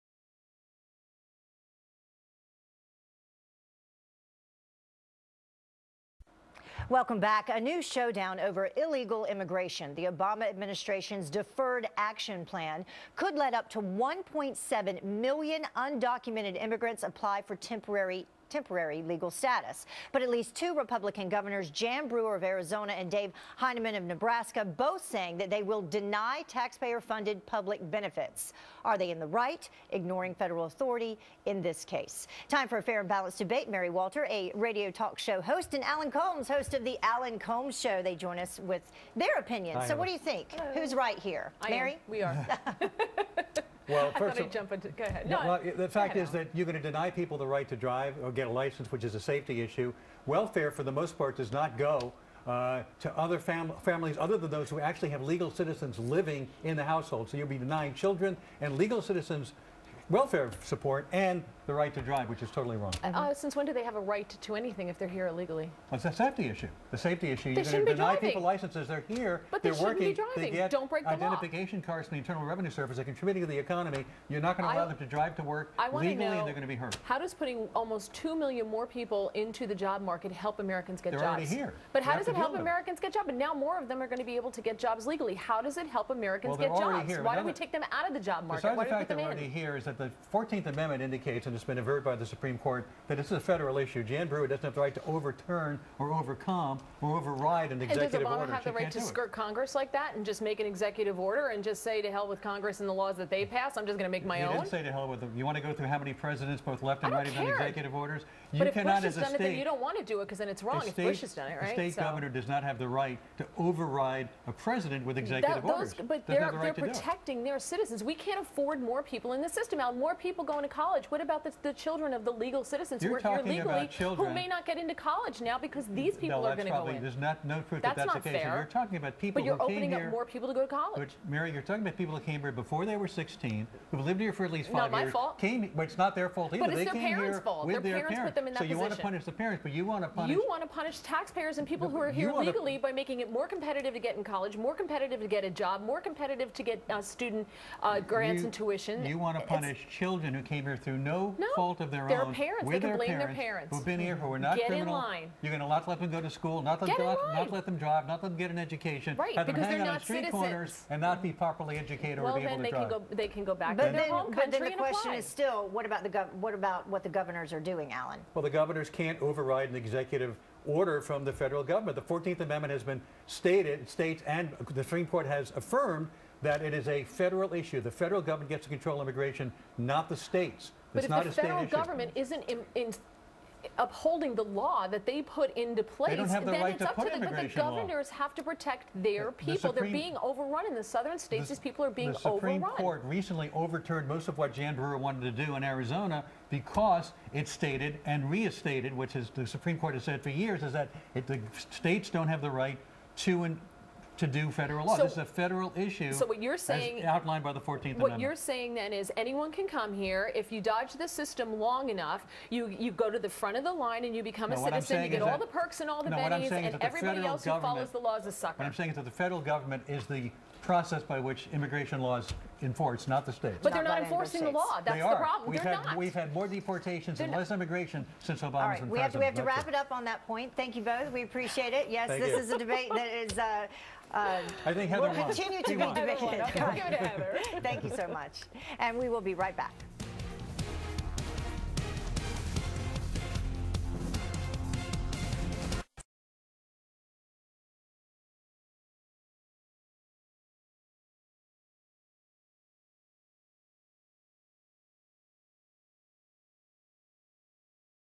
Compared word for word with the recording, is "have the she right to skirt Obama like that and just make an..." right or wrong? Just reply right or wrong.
wrong.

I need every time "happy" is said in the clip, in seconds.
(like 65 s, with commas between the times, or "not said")
not said.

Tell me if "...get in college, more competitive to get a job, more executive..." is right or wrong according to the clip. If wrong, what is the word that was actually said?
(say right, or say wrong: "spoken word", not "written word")
wrong: "competitive", not "executive".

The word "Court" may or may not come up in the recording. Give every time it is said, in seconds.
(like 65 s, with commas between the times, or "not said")
92 s, 175 s, 192 s, 199 s.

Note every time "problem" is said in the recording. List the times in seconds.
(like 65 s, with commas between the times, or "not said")
225 s.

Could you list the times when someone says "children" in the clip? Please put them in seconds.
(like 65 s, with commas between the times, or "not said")
57 s, 121 s, 149 s.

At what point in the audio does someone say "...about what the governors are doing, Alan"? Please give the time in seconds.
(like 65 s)
166 s.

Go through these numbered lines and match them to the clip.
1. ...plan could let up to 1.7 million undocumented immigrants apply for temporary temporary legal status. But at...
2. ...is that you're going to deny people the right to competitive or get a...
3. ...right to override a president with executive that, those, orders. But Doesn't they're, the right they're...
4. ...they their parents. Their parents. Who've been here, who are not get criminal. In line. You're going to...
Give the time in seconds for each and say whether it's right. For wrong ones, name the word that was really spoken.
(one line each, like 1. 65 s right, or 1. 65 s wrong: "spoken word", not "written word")
1. 12 s right
2. 46 s wrong: "drive", not "competitive"
3. 112 s right
4. 152 s right.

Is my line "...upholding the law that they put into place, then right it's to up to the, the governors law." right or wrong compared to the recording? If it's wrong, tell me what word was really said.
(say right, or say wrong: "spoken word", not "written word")
right.